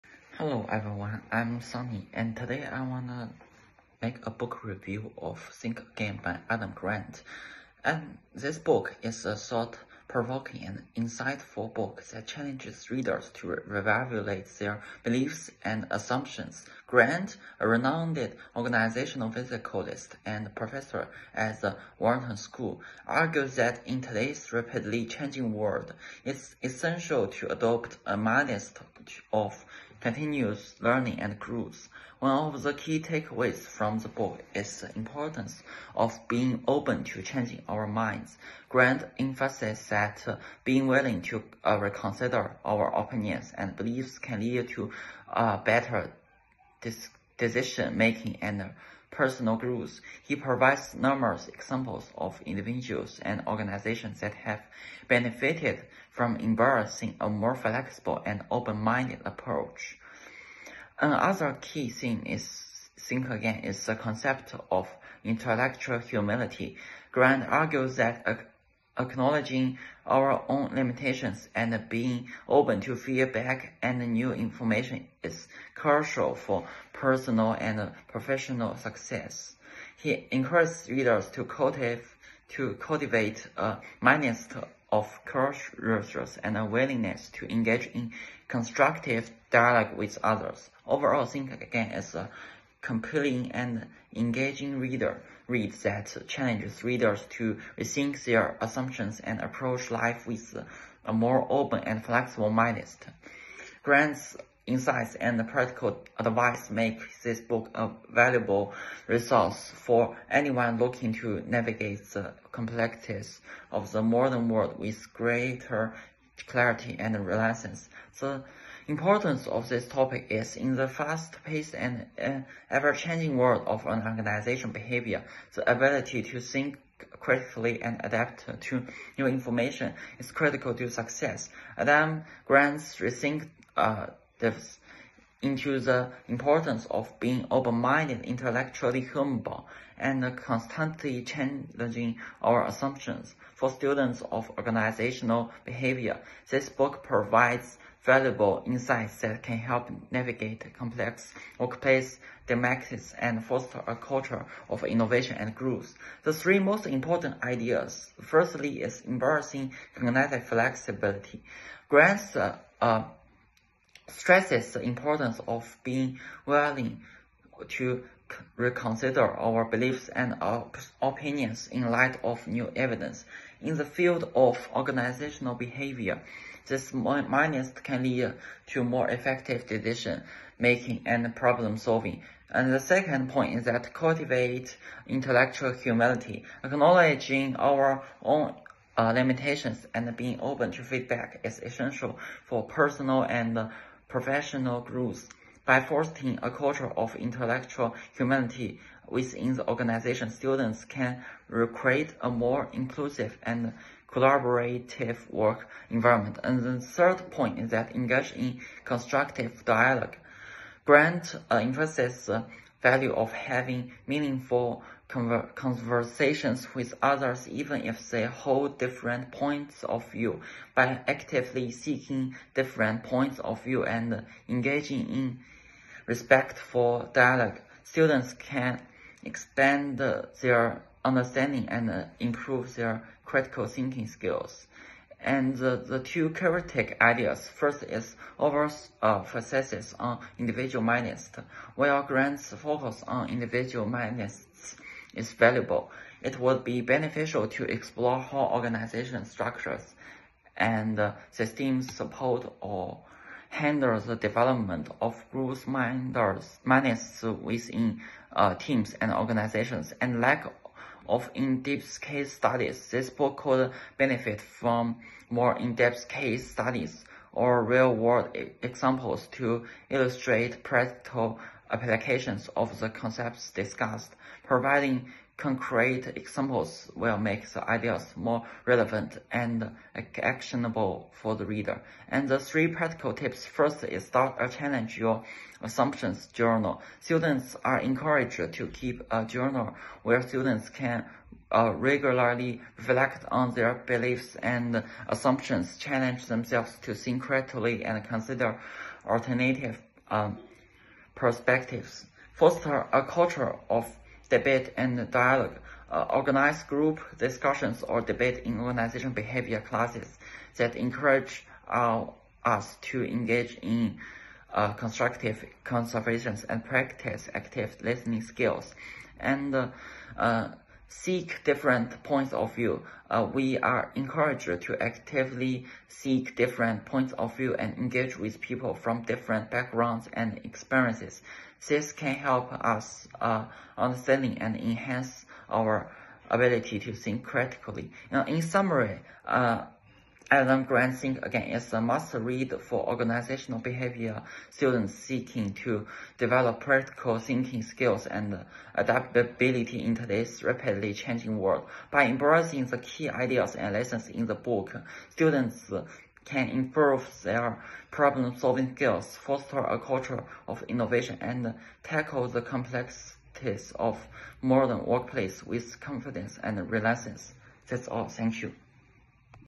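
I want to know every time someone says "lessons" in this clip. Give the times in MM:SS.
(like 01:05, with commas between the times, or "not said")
05:53.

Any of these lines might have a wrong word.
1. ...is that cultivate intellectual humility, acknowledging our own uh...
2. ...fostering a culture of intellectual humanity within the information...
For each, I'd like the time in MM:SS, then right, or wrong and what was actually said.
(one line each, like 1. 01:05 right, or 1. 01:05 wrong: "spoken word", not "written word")
1. 03:03 right
2. 03:15 wrong: "organization", not "information".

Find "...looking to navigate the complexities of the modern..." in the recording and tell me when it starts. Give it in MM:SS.
01:50.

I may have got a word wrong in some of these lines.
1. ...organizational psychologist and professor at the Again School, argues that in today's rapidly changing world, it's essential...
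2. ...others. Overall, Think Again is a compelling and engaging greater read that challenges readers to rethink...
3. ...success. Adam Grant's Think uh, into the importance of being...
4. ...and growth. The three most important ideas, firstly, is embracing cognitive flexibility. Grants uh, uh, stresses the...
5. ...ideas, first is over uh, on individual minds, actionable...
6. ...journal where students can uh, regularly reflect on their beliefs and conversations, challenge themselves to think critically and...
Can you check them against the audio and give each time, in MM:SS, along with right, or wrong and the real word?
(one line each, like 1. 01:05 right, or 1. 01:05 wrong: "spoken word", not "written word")
1. 00:18 wrong: "Wharton", not "Again"
2. 01:30 wrong: "reader", not "greater"
3. 02:10 wrong: "Rethink", not "Think"
4. 02:35 right
5. 03:57 wrong: "while", not "actionable"
6. 04:49 wrong: "assumptions", not "conversations".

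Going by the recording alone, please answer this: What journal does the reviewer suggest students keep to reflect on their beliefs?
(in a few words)
Challenge your assumptions journal.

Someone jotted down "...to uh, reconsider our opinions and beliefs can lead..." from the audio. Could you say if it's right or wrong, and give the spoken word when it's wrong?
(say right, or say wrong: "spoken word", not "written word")
right.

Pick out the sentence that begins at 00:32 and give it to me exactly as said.
One of the key takeaways from the book is the importance of being open to changing our minds.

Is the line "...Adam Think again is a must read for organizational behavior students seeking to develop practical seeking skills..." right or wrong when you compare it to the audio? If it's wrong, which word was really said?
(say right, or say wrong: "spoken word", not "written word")
wrong: "thinking", not "seeking".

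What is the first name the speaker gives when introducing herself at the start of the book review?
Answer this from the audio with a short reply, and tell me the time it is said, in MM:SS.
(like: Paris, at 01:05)
Sunny, at 00:01.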